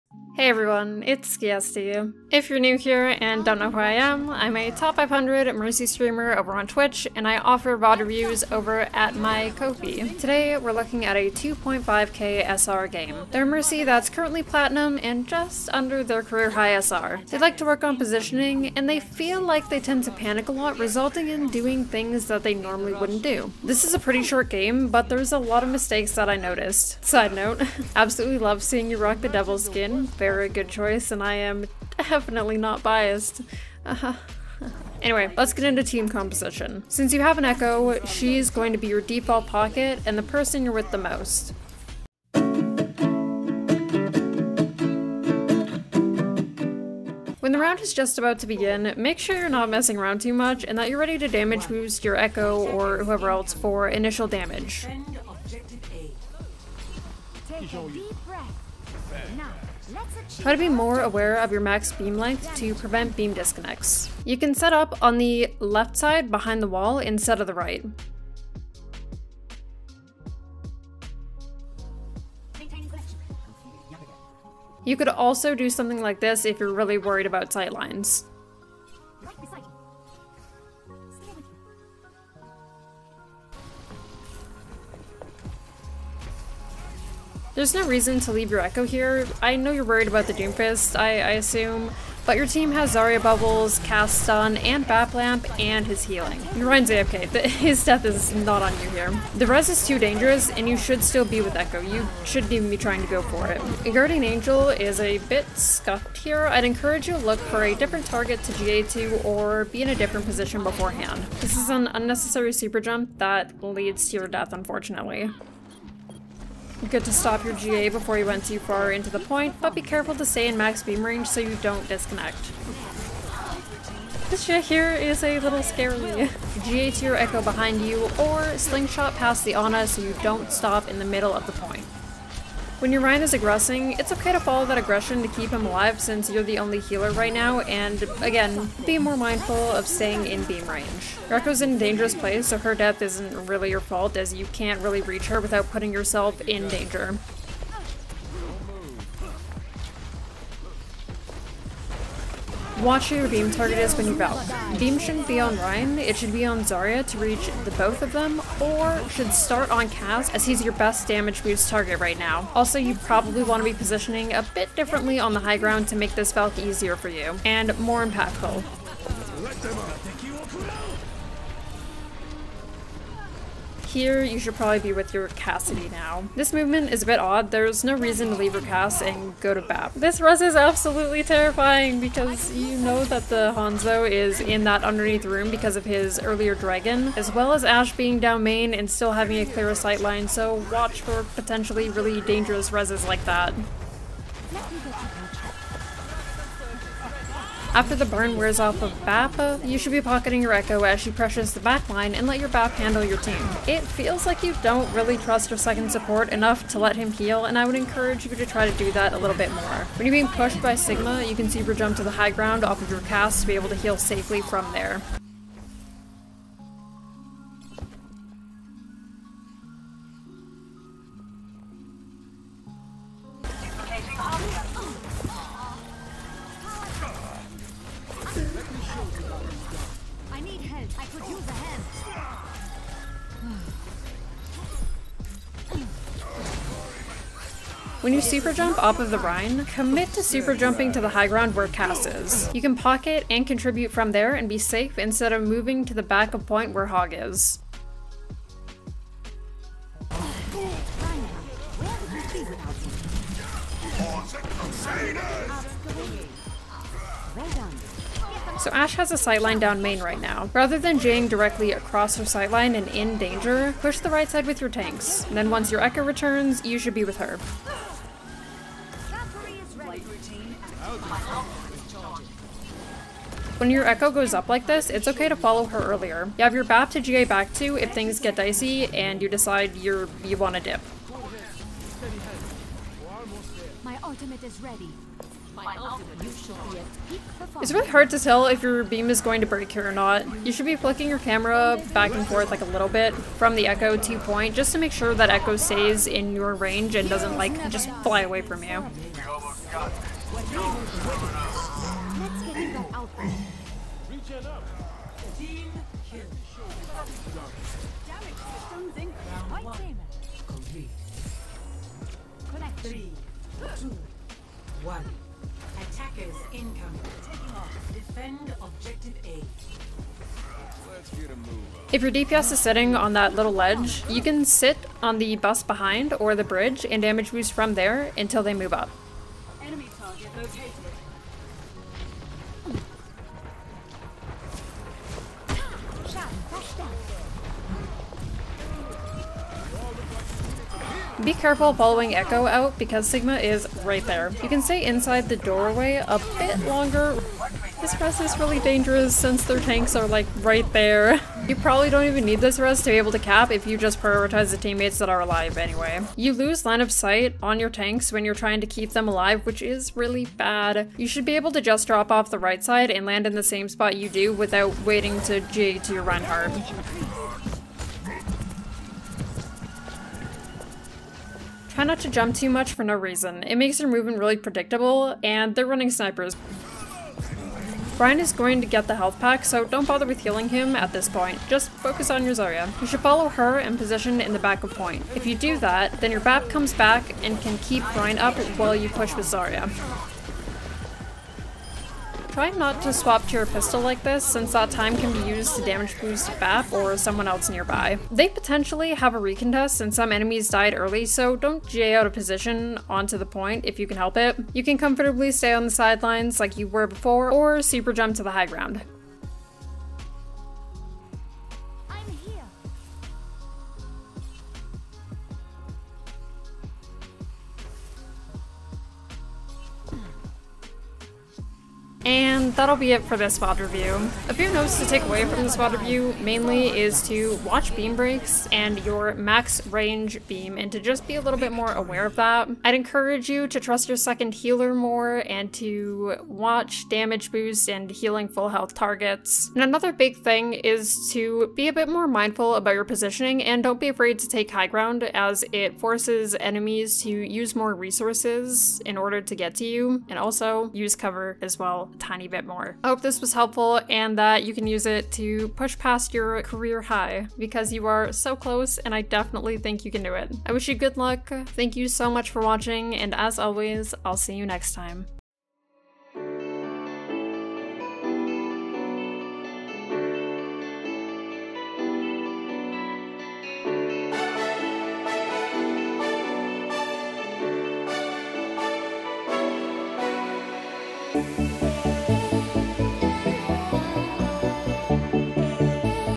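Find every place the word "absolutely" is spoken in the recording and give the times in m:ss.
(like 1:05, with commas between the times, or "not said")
0:27, 3:00.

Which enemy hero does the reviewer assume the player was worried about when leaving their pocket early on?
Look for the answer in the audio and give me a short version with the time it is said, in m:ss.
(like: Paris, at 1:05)
Doomfist, at 1:30.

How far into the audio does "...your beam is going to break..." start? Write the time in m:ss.
4:48.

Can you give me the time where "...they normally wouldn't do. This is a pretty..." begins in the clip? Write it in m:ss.
0:22.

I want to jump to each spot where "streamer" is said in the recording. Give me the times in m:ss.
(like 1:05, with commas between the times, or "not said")
0:05.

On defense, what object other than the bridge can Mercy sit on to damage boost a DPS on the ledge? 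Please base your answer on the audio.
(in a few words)
the bus.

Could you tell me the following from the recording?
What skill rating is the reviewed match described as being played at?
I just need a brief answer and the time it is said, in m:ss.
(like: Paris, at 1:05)
2.5k, at 0:11.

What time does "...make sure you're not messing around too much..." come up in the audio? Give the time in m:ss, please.
0:48.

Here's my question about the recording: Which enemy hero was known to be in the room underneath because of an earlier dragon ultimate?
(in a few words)
Hanzo.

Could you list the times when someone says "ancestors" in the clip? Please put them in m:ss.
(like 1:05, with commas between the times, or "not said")
not said.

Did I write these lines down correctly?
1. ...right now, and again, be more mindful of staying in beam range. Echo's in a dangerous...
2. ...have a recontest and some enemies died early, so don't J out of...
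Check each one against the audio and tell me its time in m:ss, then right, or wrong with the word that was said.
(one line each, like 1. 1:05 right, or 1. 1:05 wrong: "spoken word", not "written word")
1. 2:17 right
2. 6:38 right.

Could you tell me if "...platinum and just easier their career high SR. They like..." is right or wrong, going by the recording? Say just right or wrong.
wrong.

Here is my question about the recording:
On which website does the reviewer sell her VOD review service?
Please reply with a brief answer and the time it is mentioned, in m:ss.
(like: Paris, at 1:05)
Ko-fi, at 0:09.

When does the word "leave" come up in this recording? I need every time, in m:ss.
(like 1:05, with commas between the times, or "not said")
1:28, 2:58.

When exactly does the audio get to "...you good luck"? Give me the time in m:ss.
7:40.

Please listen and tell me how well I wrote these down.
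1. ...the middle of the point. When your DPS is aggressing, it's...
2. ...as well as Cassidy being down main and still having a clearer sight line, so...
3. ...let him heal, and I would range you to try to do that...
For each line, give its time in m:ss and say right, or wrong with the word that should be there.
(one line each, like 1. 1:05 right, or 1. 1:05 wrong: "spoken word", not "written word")
1. 2:10 wrong: "Rein", not "DPS"
2. 3:07 wrong: "Ash", not "Cassidy"
3. 3:26 wrong: "encourage", not "range".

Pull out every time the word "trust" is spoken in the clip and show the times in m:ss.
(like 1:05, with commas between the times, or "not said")
3:25, 7:13.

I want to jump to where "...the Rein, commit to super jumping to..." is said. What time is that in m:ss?
3:59.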